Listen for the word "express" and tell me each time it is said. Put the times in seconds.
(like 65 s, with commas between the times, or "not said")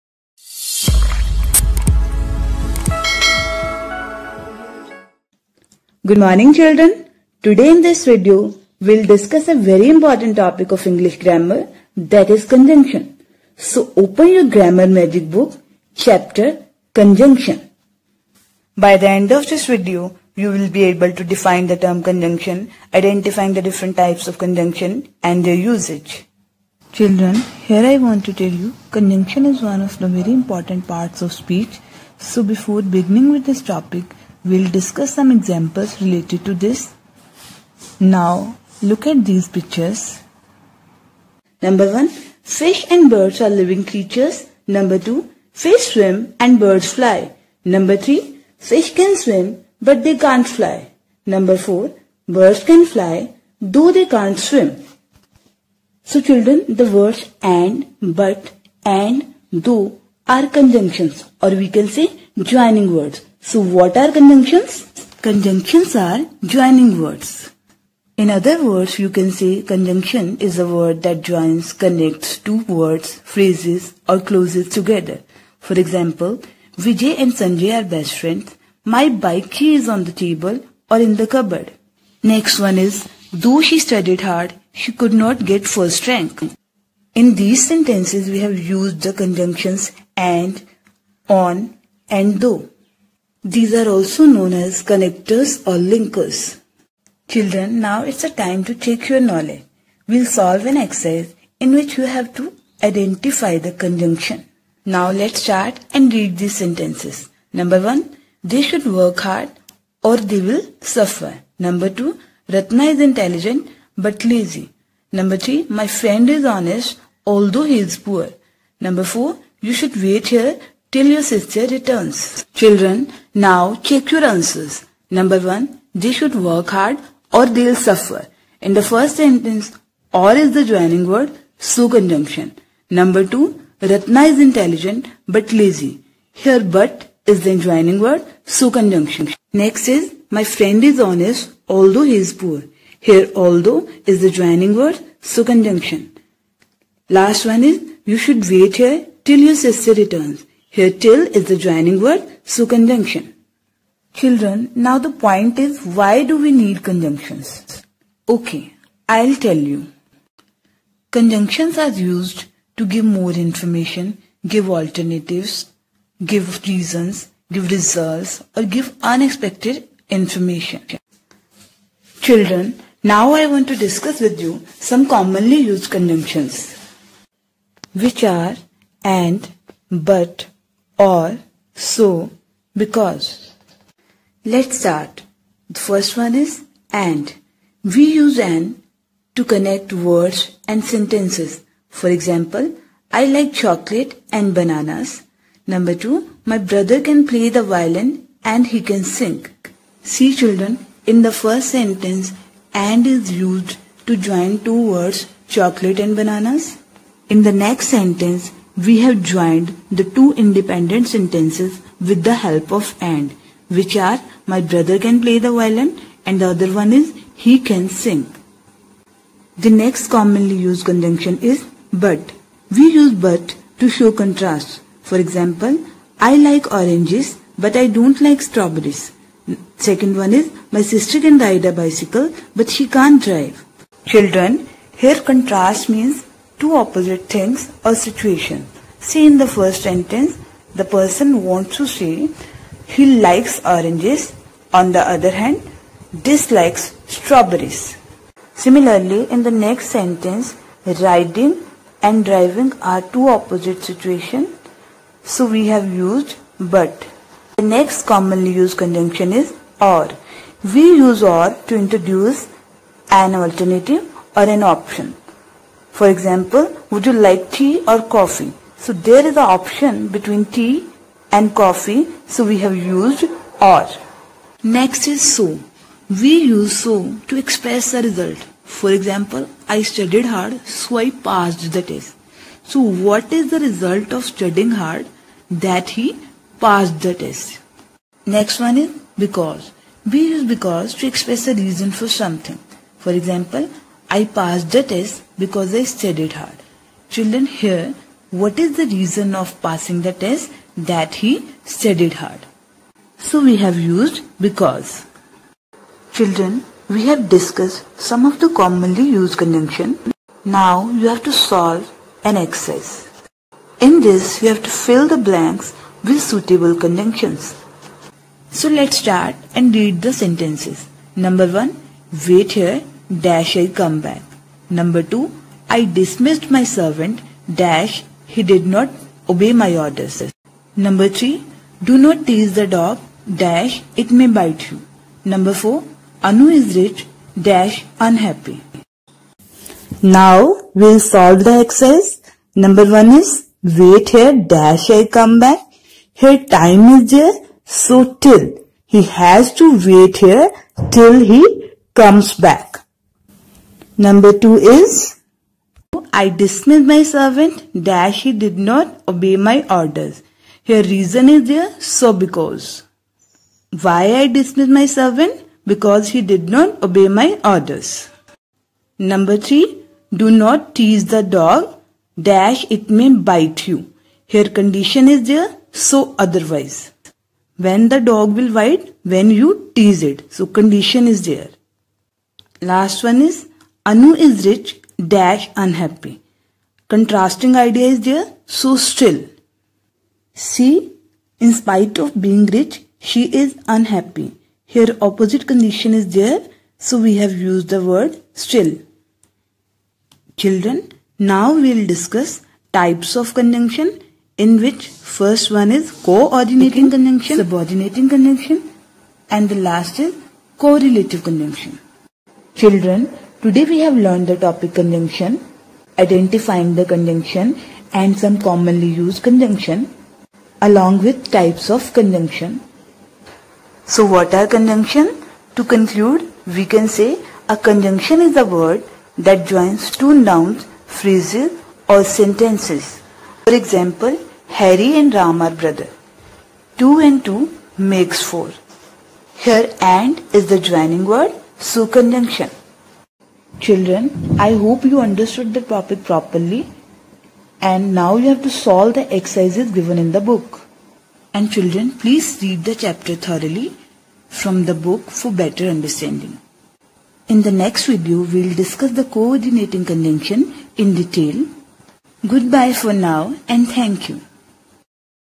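277 s, 291 s.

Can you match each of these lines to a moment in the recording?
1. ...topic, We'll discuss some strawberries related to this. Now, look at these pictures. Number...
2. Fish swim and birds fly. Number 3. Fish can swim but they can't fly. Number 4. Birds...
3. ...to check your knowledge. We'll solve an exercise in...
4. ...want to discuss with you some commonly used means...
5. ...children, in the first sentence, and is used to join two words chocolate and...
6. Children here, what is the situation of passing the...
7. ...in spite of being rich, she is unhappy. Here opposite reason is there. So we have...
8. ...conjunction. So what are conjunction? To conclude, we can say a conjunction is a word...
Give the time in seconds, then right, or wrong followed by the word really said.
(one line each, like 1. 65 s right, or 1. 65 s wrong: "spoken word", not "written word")
1. 33 s wrong: "examples", not "strawberries"
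2. 45 s right
3. 98 s right
4. 173 s wrong: "conjunctions", not "means"
5. 200 s right
6. 297 s wrong: "reason", not "situation"
7. 391 s wrong: "condition", not "reason"
8. 421 s right.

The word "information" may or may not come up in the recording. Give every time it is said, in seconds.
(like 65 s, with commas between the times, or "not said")
163 s, 170 s.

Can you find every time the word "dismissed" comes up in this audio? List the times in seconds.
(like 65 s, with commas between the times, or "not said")
325 s, 356 s, 364 s.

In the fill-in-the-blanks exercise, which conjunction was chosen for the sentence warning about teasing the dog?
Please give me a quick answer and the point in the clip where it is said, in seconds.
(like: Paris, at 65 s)
otherwise, at 376 s.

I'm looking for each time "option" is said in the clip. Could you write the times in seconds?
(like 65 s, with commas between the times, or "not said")
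264 s, 269 s.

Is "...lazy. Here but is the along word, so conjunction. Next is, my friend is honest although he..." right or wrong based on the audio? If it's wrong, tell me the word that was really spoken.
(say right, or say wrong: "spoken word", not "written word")
wrong: "joining", not "along".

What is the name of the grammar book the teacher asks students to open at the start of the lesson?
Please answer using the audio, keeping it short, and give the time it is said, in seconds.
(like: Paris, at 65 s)
Grammar Magic, at 14 s.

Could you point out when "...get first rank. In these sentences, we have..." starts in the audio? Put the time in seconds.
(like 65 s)
85 s.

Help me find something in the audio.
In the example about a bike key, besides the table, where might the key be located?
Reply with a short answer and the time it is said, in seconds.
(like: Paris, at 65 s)
in the cupboard, at 80 s.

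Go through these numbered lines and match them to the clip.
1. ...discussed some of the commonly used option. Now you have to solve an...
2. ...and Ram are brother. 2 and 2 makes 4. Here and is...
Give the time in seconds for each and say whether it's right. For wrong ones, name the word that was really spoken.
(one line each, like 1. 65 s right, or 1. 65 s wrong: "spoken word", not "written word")
1. 307 s wrong: "conjunction", not "option"
2. 434 s right.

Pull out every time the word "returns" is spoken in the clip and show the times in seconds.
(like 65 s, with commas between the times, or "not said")
121 s, 149 s.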